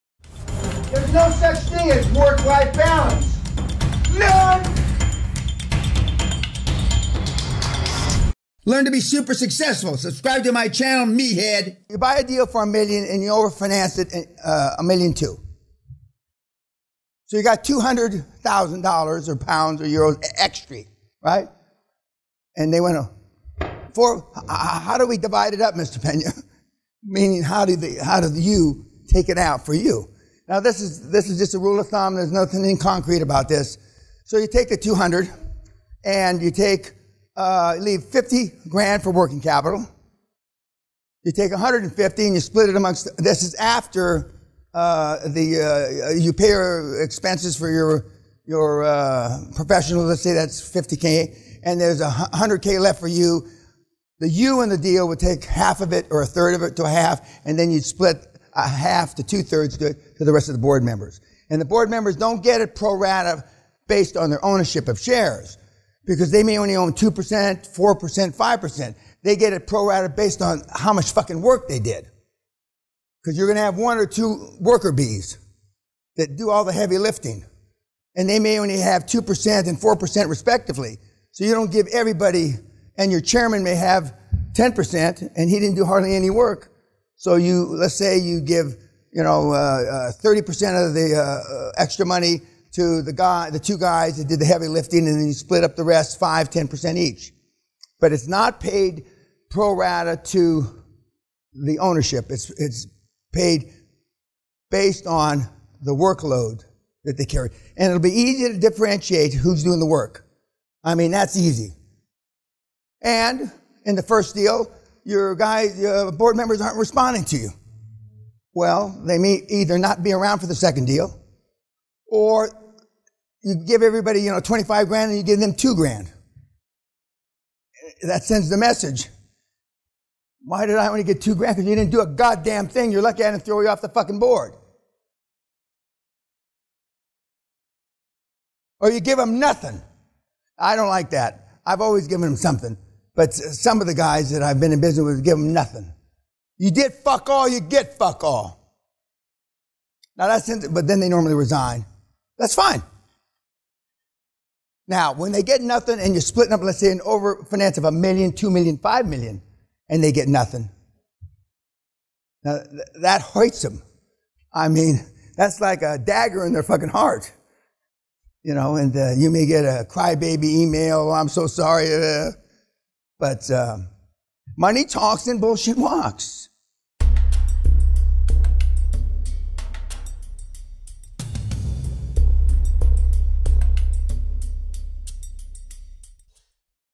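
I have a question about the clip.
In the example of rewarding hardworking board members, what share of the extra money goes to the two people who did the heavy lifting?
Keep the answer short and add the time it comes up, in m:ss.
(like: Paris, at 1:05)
30%, at 1:30.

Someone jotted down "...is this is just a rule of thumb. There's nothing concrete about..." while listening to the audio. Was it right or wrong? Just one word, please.
right.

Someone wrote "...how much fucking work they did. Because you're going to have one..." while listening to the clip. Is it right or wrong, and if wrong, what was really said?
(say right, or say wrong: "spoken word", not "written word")
right.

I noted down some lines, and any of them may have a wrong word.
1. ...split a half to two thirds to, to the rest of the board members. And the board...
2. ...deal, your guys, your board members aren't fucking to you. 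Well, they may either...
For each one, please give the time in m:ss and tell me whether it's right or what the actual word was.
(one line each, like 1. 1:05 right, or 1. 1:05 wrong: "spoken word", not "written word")
1. 0:57 right
2. 1:54 wrong: "responding", not "fucking".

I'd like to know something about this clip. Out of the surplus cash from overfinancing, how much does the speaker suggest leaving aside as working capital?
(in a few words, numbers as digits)
50,000.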